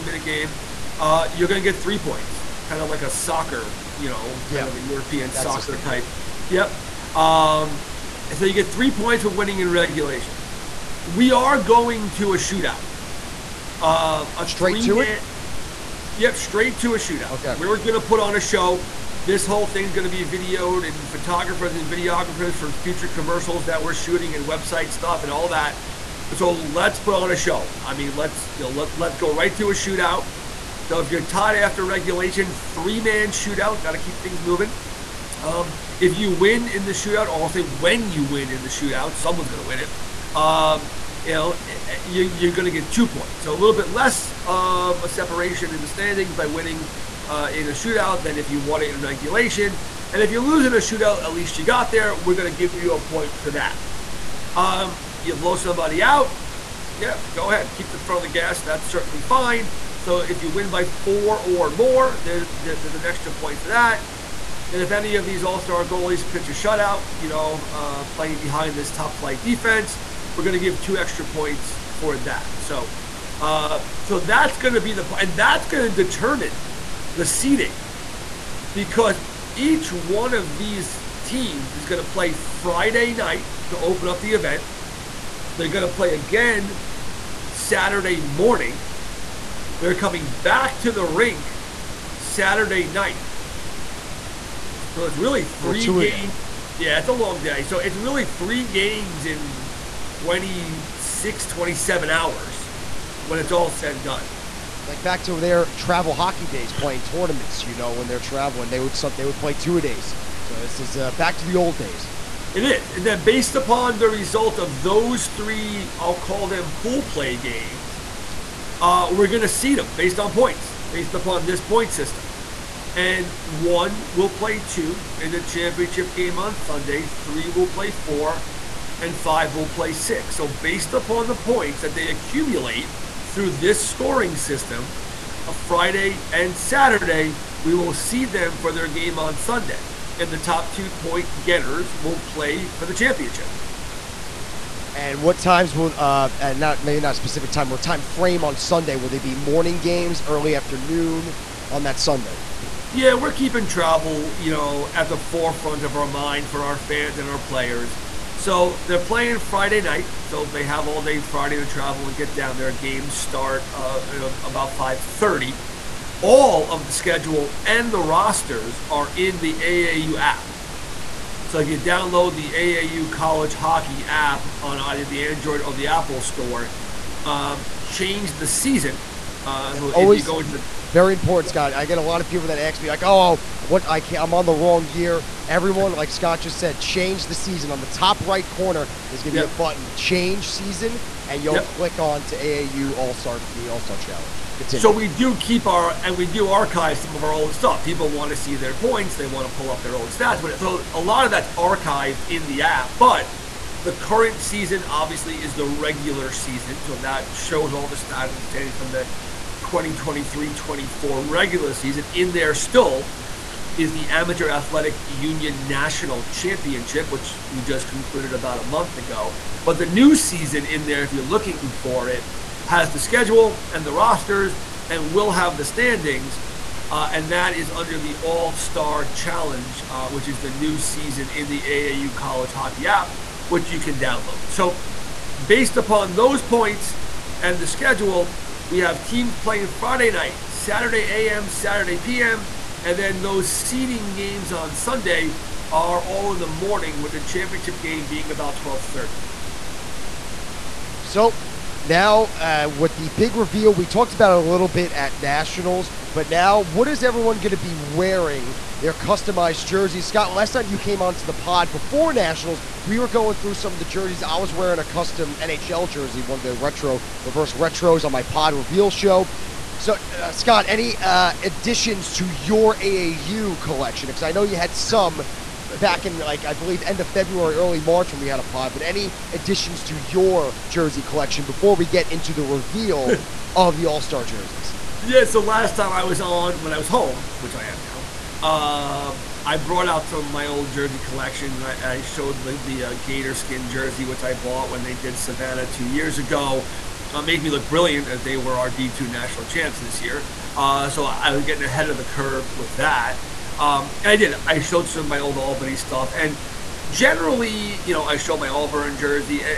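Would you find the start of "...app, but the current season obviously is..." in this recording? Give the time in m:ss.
3:22.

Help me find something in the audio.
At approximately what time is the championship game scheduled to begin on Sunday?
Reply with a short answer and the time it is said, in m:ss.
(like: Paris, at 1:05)
12:30, at 4:08.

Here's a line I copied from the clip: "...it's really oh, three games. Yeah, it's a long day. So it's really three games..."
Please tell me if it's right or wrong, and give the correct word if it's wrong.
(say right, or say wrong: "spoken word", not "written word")
right.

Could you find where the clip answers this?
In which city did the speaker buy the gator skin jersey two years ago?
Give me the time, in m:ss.
4:55.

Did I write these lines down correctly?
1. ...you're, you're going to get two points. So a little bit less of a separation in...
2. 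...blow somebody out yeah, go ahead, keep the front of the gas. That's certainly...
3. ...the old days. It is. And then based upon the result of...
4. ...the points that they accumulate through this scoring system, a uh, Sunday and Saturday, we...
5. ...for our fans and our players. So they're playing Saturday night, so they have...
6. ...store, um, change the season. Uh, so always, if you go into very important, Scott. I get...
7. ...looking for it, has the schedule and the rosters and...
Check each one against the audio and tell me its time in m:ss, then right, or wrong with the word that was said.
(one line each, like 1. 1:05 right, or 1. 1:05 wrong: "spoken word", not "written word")
1. 0:42 right
2. 0:55 right
3. 1:51 right
4. 2:11 wrong: "Friday", not "Sunday"
5. 2:36 wrong: "Friday", not "Saturday"
6. 2:56 right
7. 3:41 right.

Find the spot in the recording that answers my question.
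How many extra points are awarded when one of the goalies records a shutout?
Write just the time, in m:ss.
1:10.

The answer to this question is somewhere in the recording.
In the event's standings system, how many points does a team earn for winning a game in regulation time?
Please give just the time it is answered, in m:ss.
0:08.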